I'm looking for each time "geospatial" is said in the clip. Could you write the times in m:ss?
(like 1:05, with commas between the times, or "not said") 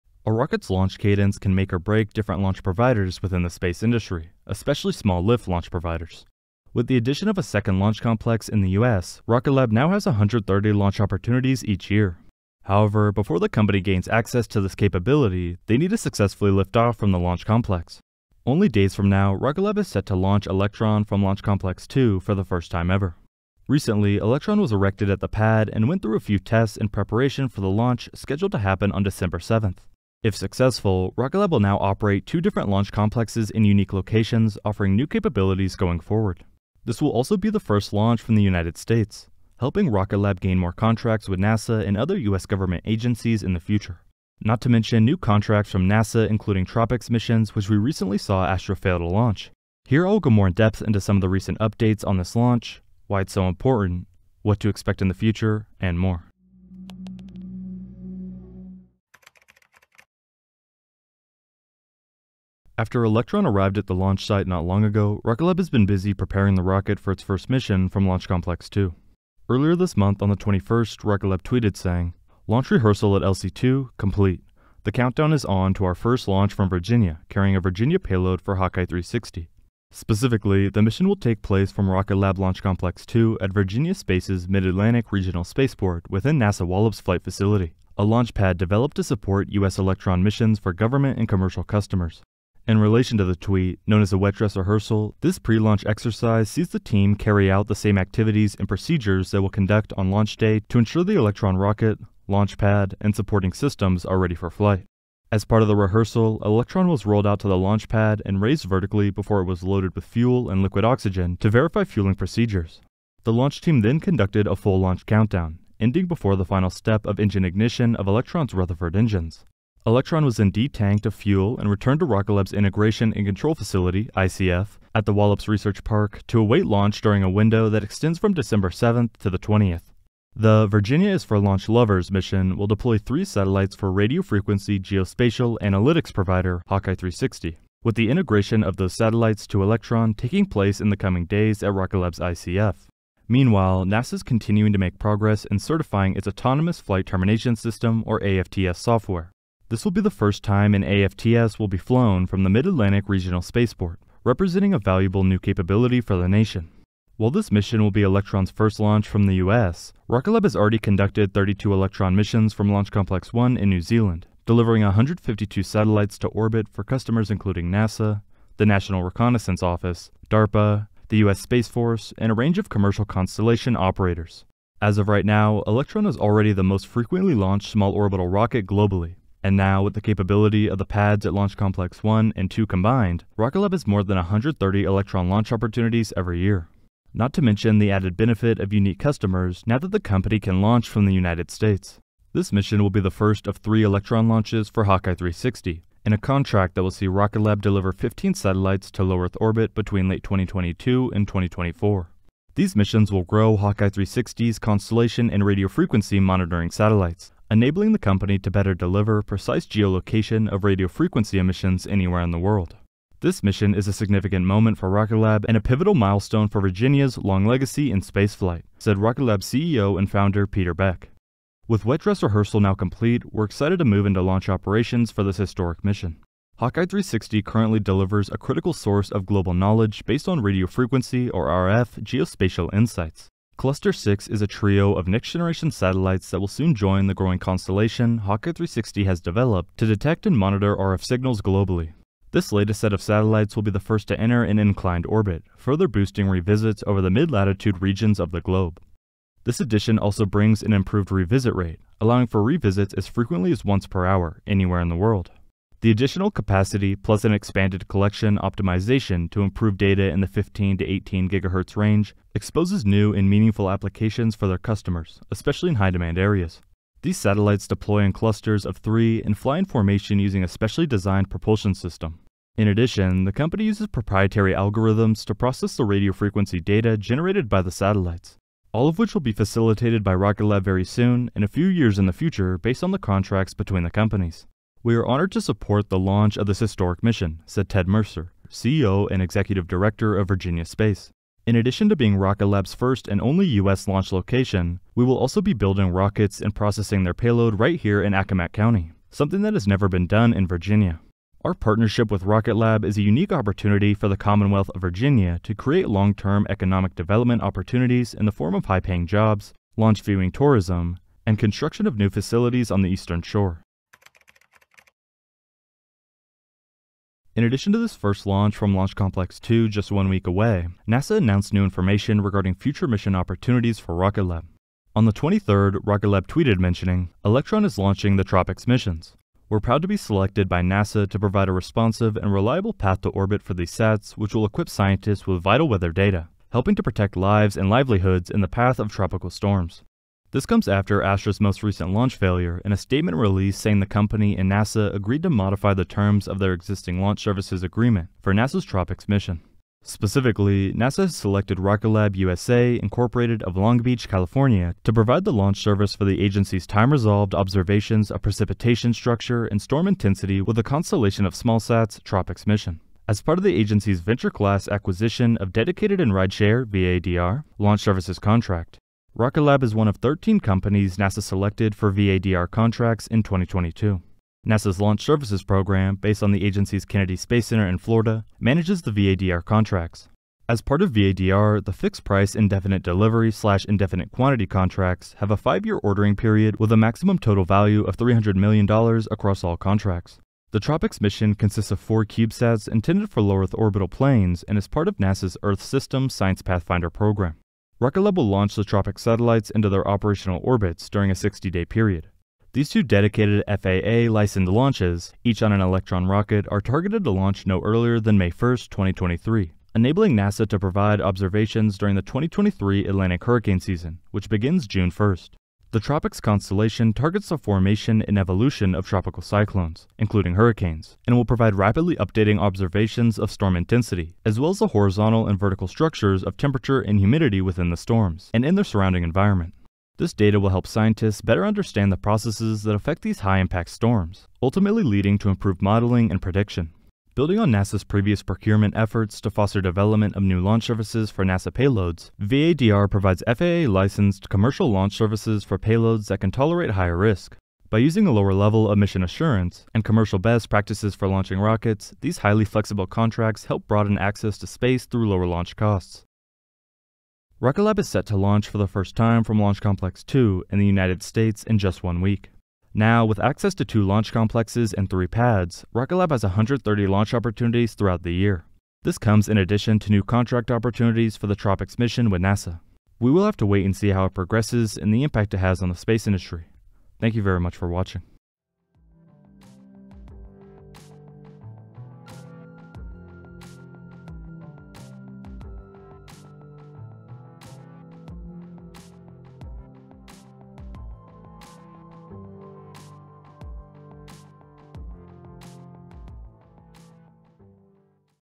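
2:14, 3:52.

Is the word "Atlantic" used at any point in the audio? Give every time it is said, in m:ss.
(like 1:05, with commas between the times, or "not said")
1:24, 2:32, 6:52.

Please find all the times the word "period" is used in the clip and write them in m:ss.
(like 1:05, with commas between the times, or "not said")
6:26, 6:41.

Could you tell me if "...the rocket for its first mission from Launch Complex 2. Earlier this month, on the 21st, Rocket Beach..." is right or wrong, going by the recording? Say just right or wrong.
wrong.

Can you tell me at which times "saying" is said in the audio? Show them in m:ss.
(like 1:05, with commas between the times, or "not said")
1:11, 5:43.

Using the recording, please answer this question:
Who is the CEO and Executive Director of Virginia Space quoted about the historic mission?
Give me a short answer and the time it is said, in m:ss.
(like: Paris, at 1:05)
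Ted Mercer, at 4:47.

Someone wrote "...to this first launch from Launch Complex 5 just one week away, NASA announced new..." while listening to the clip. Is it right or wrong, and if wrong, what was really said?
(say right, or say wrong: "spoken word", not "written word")
wrong: "2", not "5".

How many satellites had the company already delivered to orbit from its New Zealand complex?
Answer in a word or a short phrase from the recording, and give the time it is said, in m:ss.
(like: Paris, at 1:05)
152, at 2:44.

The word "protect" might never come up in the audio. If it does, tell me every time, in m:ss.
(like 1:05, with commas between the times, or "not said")
5:36.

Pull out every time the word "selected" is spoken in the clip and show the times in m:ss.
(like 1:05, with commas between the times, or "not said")
5:29, 5:51, 6:11.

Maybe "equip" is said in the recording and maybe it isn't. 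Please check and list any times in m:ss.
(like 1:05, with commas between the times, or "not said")
5:34.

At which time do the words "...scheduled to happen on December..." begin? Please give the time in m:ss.
0:28.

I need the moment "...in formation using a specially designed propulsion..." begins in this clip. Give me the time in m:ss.
4:29.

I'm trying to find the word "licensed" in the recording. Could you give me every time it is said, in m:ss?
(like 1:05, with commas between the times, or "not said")
6:43, 7:23.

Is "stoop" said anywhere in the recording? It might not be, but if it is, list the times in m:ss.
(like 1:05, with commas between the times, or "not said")
not said.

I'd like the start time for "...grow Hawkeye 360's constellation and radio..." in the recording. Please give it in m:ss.
3:23.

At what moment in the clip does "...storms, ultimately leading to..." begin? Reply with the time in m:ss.
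7:13.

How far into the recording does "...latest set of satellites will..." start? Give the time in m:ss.
4:02.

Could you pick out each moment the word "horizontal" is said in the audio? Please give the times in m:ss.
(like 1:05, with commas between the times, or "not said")
7:04.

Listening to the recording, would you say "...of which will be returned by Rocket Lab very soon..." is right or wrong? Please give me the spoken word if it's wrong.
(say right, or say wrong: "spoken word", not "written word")
wrong: "facilitated", not "returned".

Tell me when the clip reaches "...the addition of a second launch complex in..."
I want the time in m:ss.
0:06.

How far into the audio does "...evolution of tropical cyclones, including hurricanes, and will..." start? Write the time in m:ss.
6:58.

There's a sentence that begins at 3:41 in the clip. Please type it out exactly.
With wet dress rehearsal now complete, we're excited to move into launch operations for this historic mission.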